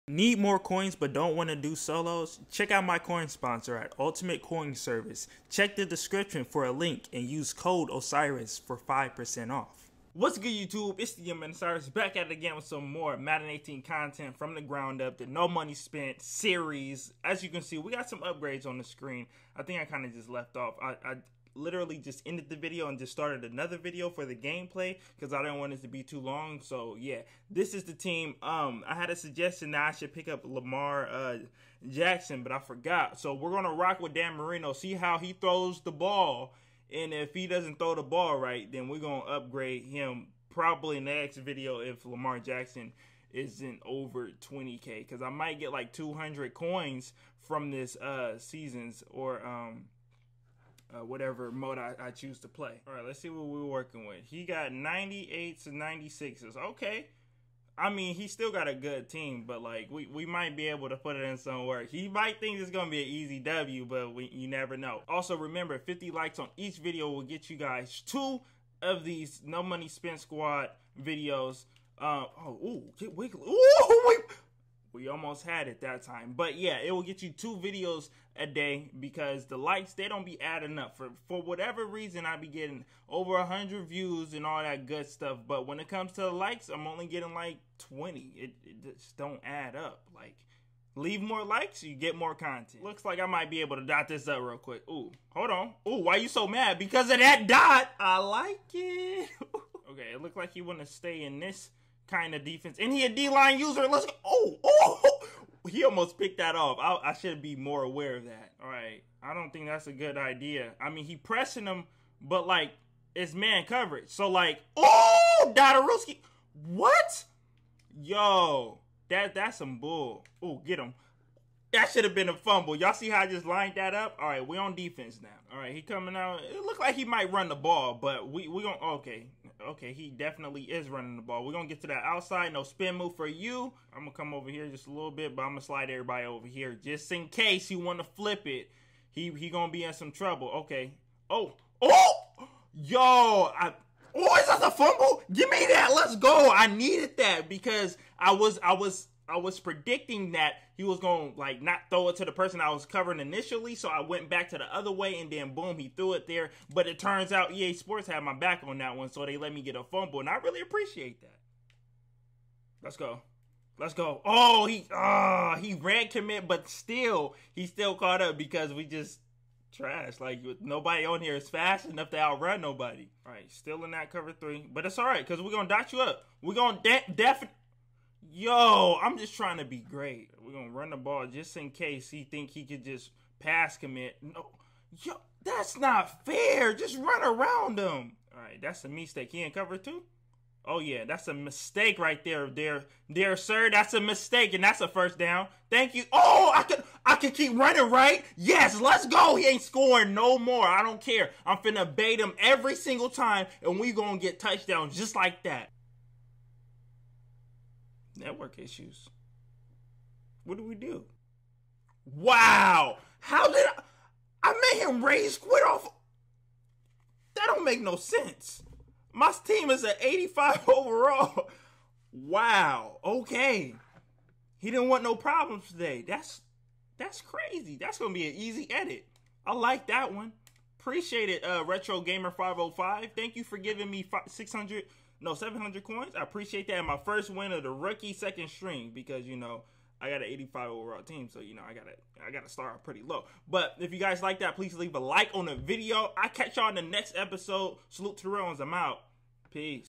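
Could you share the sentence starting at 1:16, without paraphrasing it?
But yeah, it will get you two videos a day because the likes they don't be adding up for for whatever reason.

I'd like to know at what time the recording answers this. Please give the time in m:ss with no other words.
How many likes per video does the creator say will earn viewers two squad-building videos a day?
1:05.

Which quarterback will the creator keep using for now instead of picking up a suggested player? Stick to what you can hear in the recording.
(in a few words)
Dan Marino.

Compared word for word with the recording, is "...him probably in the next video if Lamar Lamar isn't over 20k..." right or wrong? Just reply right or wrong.
wrong.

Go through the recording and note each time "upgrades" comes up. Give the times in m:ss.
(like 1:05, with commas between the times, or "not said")
0:18, 0:39.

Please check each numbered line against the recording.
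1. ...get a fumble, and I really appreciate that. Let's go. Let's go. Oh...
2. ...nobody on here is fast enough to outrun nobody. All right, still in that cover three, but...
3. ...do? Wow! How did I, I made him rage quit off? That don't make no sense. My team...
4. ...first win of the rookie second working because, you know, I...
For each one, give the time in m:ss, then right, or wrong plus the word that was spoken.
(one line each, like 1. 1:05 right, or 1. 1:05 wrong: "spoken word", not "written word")
1. 2:39 right
2. 2:50 right
3. 3:30 right
4. 3:56 wrong: "string", not "working".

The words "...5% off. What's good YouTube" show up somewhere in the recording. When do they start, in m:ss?
0:08.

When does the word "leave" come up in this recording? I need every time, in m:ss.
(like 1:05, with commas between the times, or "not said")
1:30, 4:04.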